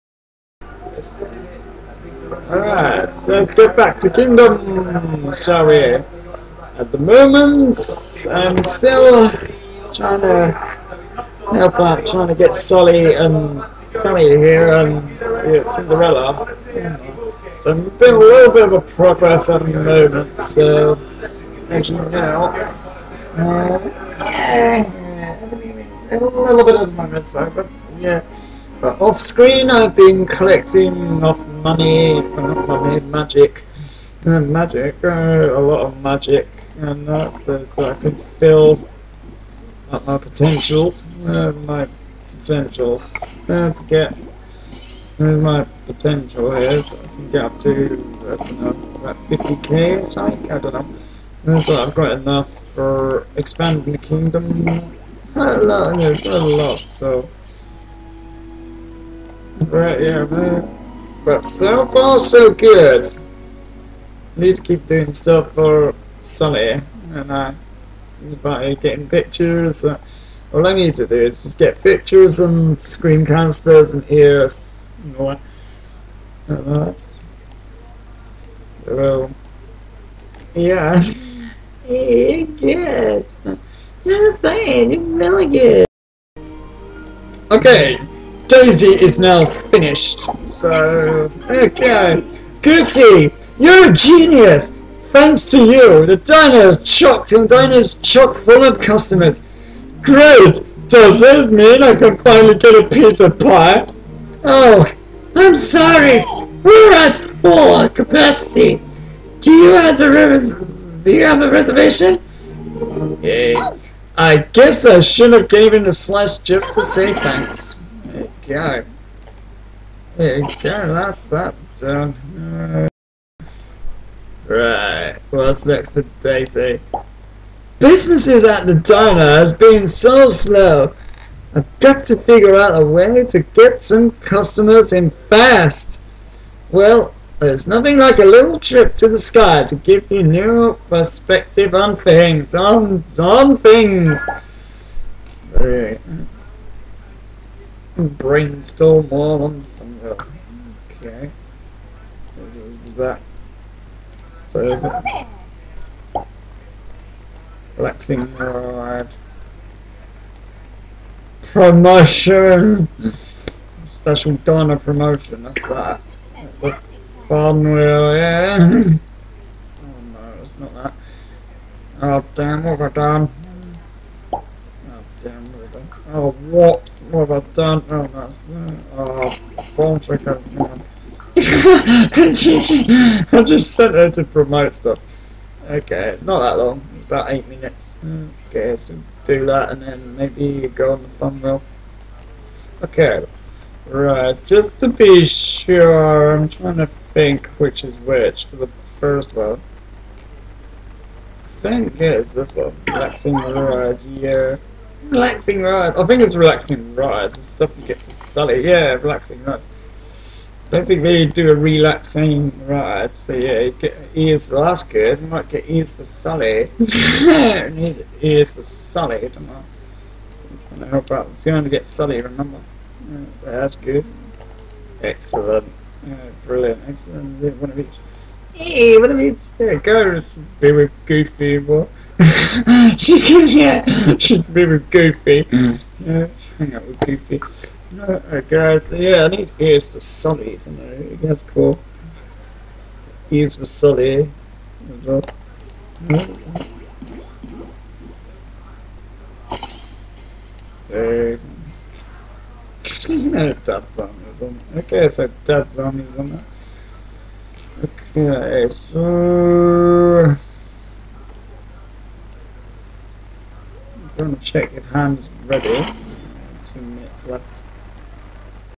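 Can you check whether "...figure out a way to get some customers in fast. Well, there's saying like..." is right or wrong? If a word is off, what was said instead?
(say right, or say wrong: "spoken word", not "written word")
wrong: "nothing", not "saying".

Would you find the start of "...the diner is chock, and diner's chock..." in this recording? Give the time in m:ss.
1:36.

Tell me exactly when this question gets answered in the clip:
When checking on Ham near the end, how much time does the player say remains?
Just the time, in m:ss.
4:26.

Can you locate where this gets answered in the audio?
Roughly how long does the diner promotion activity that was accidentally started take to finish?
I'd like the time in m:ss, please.
3:07.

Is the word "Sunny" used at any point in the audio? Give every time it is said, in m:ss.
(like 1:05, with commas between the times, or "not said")
1:06.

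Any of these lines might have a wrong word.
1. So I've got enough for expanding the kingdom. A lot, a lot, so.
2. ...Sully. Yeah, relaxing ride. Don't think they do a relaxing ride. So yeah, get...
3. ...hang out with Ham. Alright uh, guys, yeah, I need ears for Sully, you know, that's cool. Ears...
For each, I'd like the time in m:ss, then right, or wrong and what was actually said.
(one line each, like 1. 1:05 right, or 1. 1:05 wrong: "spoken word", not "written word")
1. 0:51 right
2. 3:28 right
3. 3:56 wrong: "Goofy", not "Ham".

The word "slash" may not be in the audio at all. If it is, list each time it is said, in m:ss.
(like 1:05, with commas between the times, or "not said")
1:55.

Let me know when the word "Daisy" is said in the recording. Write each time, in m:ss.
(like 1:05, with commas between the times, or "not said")
1:28, 2:06.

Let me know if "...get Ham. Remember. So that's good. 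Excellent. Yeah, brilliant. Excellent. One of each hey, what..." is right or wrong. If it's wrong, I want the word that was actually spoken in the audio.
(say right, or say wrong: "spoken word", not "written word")
wrong: "Sully", not "Ham".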